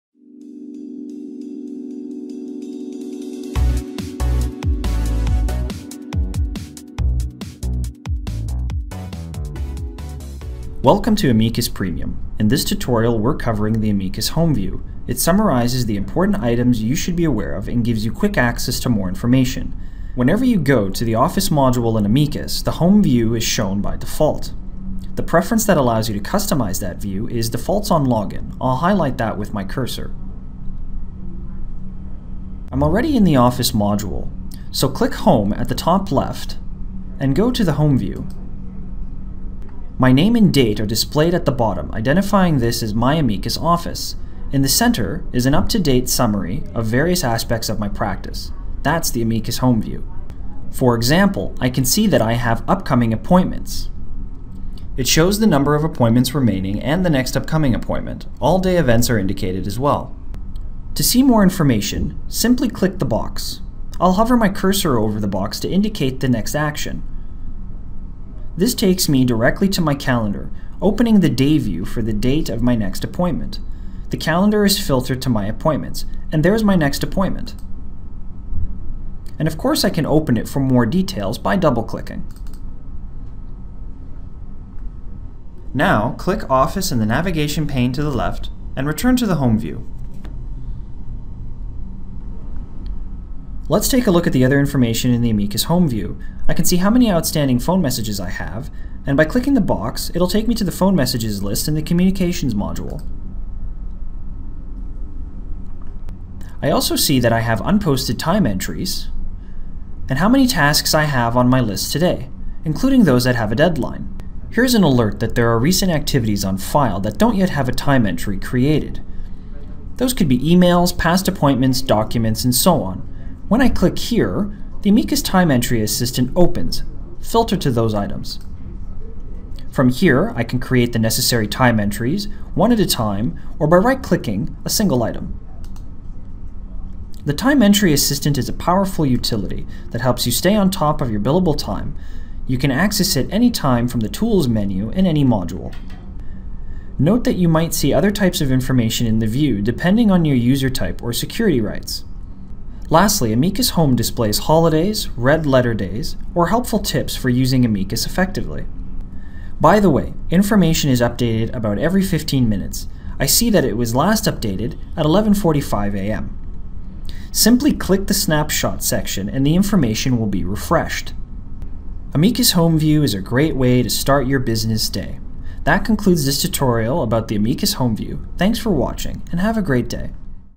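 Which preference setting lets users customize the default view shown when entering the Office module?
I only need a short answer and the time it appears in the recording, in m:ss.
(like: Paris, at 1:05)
Defaults on Login, at 0:27.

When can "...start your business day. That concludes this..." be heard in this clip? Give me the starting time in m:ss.
2:53.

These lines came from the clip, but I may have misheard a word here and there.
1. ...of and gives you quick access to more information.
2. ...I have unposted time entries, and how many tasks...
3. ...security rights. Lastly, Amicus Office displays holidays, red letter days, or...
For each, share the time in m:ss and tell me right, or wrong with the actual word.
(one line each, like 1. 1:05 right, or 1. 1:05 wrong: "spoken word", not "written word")
1. 0:17 right
2. 1:47 right
3. 2:31 wrong: "Home", not "Office".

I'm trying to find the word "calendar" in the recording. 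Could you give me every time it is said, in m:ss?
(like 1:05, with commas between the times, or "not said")
1:09, 1:14.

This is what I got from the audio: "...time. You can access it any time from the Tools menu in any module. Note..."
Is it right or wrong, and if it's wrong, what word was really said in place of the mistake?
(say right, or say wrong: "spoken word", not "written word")
right.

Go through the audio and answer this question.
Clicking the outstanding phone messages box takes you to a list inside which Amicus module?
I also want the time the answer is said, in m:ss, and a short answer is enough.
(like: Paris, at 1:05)
Communications, at 1:41.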